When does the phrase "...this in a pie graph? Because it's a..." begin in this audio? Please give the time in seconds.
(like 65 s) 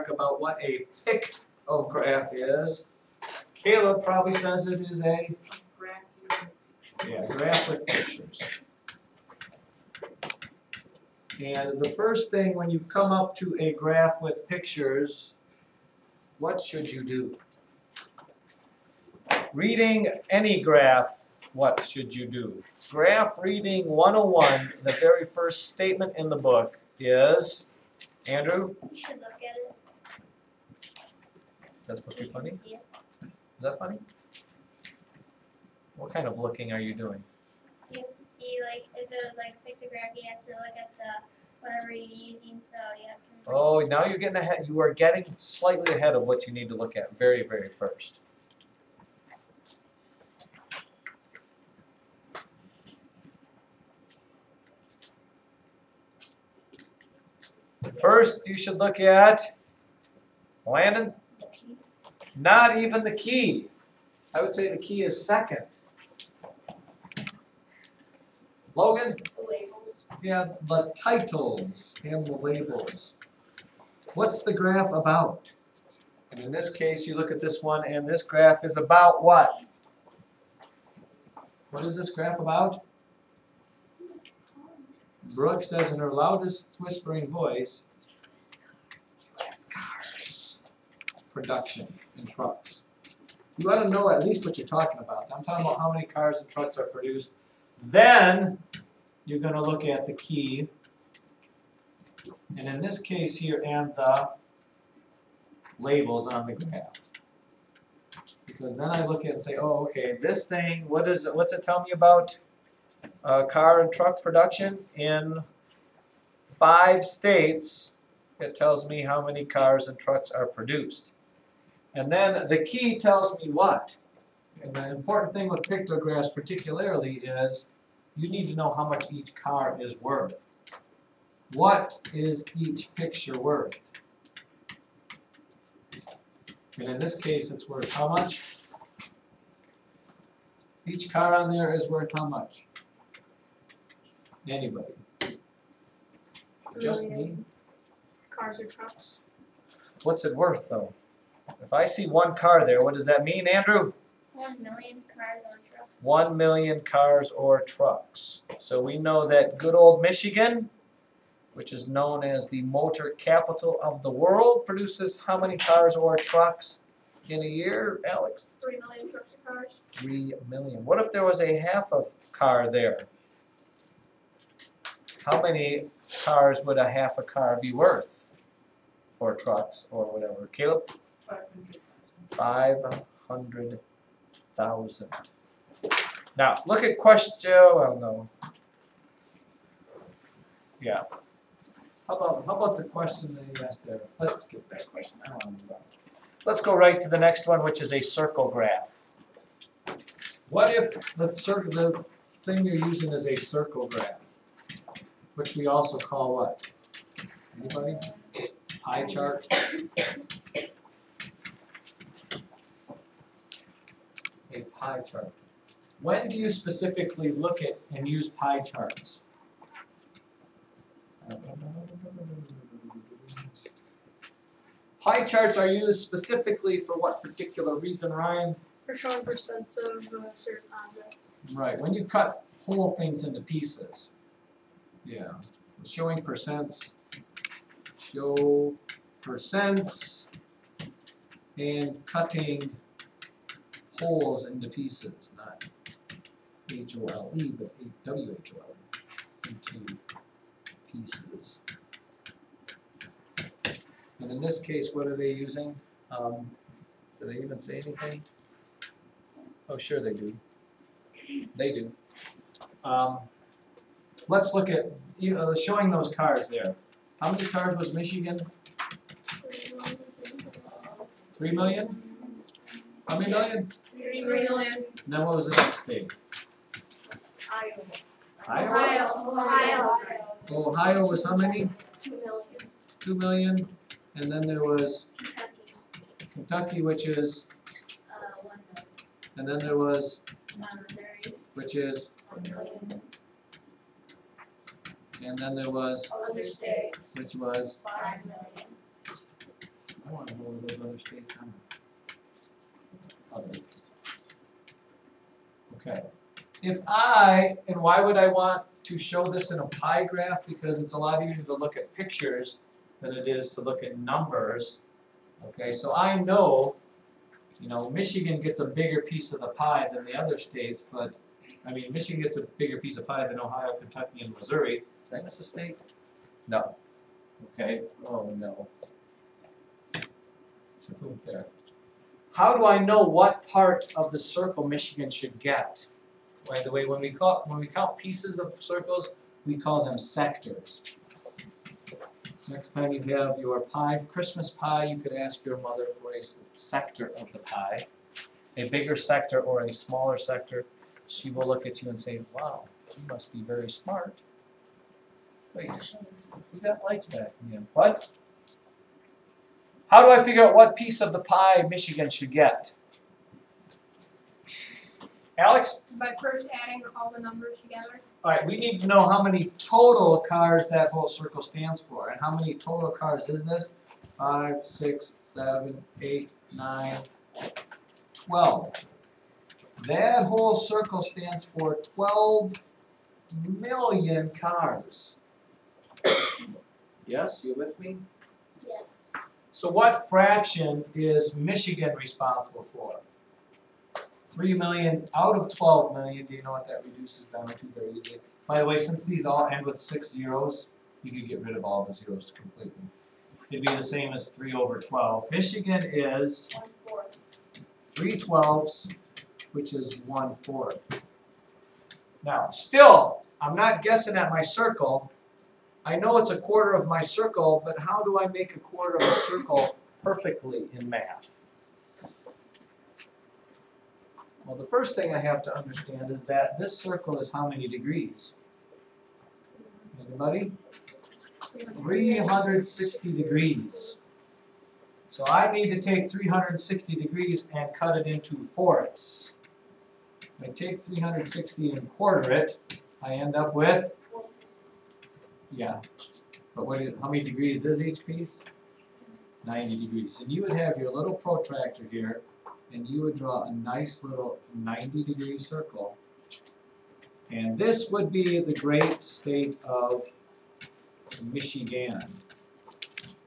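309 s.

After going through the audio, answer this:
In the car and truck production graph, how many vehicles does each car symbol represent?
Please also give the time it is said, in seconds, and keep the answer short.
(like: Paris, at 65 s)
1,000,000, at 156 s.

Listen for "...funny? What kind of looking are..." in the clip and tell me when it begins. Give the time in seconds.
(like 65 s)
33 s.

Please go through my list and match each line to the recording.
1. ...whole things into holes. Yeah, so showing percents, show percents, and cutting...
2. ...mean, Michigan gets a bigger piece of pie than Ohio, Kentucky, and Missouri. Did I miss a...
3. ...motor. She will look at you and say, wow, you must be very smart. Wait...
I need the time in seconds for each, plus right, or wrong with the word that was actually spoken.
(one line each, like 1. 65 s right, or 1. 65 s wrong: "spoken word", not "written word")
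1. 232 s wrong: "pieces", not "holes"
2. 321 s right
3. 350 s wrong: "sector", not "motor".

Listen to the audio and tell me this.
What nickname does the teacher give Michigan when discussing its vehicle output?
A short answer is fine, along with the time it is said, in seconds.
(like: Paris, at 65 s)
motor capital of the world, at 162 s.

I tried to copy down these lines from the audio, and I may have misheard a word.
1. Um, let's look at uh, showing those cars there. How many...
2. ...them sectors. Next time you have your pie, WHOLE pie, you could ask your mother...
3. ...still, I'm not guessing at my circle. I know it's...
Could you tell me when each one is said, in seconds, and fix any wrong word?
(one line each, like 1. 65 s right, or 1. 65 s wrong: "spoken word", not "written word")
1. 262 s right
2. 339 s wrong: "Christmas", not "WHOLE"
3. 412 s right.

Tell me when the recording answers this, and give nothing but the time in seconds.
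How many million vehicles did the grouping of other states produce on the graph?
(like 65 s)
297 s.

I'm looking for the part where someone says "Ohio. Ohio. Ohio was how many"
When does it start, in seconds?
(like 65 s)
278 s.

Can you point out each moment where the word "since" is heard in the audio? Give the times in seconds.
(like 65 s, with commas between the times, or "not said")
398 s.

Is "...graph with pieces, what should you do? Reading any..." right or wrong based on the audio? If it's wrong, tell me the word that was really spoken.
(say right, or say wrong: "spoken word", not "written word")
wrong: "pictures", not "pieces".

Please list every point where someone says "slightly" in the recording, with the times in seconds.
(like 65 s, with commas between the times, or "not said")
45 s.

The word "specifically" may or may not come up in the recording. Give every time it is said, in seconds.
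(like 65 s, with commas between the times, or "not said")
216 s, 225 s.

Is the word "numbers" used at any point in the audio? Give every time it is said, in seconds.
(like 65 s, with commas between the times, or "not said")
313 s, 367 s.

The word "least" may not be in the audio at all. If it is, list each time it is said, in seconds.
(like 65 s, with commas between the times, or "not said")
94 s.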